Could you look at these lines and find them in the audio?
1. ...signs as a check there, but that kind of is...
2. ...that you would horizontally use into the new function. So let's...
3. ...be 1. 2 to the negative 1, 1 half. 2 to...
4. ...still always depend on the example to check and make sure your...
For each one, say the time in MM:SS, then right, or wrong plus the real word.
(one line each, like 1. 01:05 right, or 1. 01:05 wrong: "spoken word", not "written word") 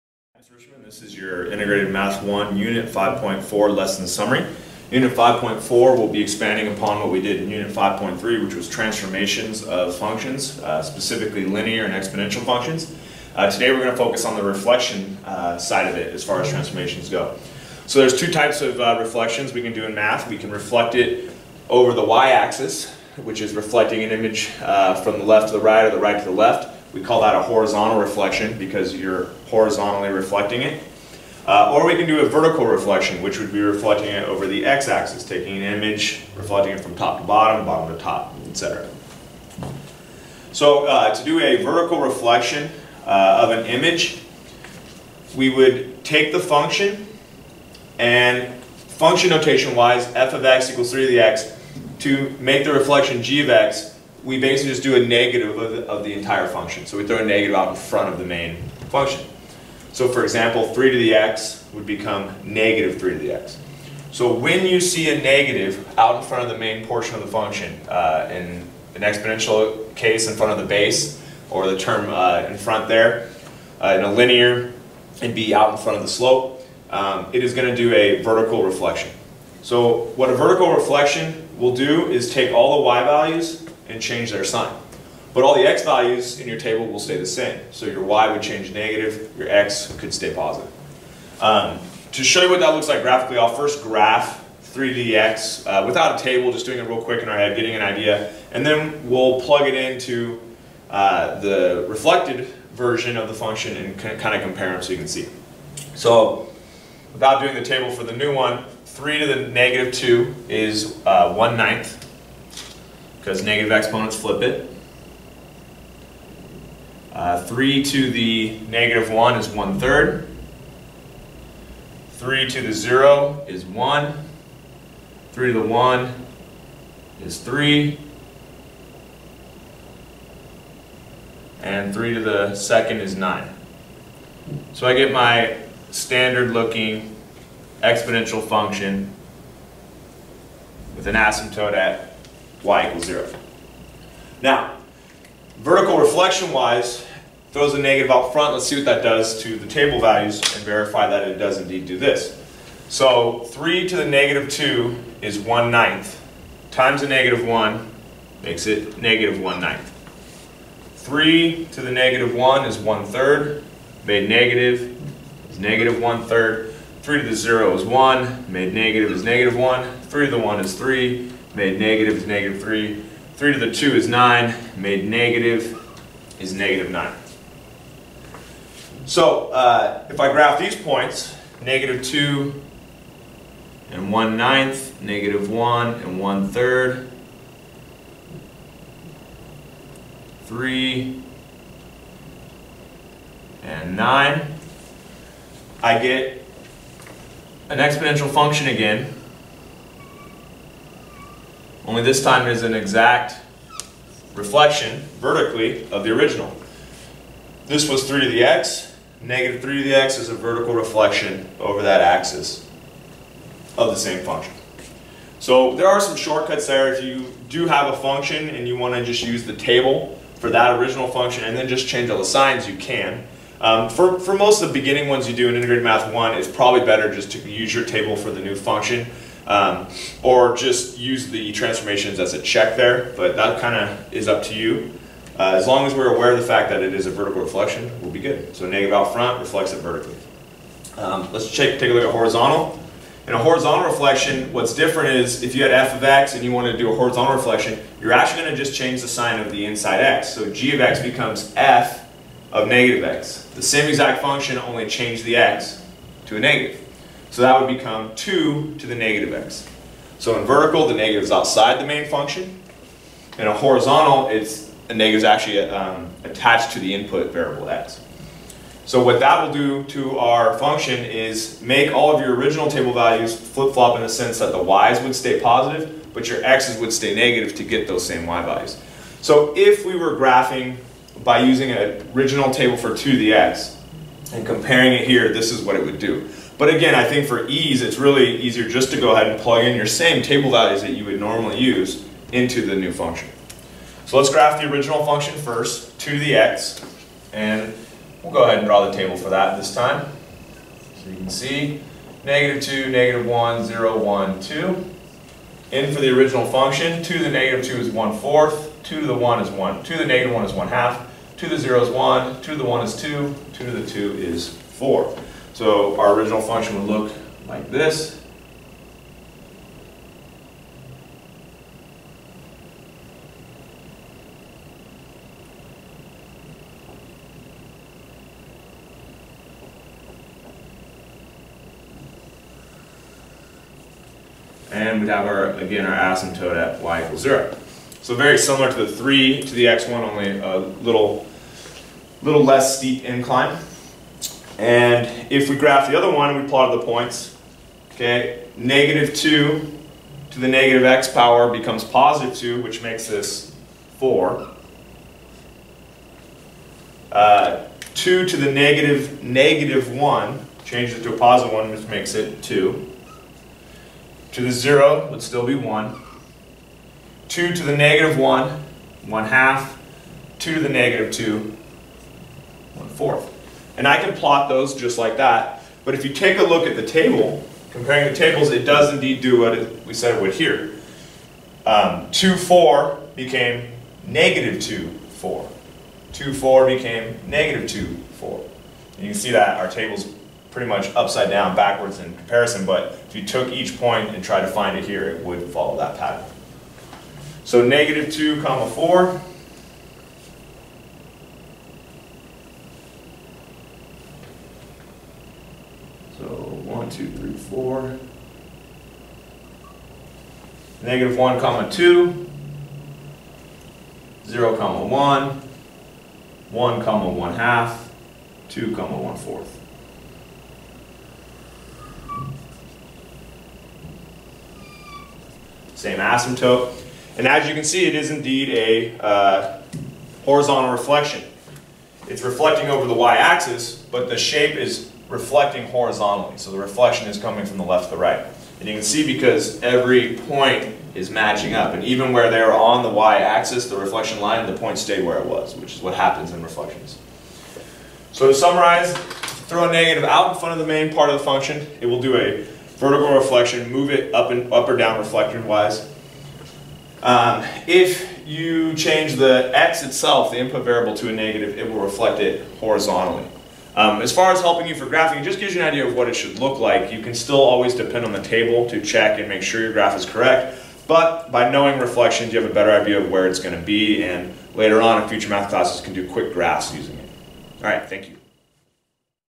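1. 03:51 wrong: "transformations", not "signs"
2. 04:50 wrong: "normally", not "horizontally"
3. 06:05 right
4. 07:47 wrong: "table", not "example".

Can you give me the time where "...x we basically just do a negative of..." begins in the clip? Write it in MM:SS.
00:53.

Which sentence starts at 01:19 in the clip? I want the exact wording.
So what a vertical reflection will do is take all the y values and change their sign.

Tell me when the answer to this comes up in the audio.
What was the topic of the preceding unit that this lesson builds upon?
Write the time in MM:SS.
00:08.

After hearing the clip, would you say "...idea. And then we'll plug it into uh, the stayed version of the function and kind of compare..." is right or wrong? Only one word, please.
wrong.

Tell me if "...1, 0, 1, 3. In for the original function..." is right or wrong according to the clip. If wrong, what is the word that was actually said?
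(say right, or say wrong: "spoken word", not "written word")
wrong: "2", not "3".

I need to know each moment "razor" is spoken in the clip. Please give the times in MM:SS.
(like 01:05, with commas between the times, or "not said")
not said.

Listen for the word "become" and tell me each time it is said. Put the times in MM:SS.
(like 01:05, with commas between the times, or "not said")
01:01, 04:11, 04:17, 05:51.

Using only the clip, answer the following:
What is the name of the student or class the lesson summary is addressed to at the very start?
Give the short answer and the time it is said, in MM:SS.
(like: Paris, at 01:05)
Richmond, at 00:00.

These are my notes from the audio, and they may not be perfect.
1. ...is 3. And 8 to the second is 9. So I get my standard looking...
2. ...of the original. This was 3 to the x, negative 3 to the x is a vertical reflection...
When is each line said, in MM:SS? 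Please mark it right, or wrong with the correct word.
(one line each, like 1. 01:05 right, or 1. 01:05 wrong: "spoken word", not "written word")
1. 02:07 wrong: "3", not "8"
2. 03:25 right.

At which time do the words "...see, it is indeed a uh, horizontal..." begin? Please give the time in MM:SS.
07:07.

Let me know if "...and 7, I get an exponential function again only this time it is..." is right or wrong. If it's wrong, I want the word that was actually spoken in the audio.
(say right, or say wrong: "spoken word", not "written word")
wrong: "9", not "7".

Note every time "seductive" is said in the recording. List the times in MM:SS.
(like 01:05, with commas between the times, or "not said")
not said.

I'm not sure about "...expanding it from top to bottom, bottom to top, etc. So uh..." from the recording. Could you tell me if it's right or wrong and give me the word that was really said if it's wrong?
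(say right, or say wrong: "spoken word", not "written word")
wrong: "reflecting", not "expanding".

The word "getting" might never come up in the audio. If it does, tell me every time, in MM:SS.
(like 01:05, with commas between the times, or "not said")
01:37.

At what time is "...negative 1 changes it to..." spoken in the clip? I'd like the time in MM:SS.
05:59.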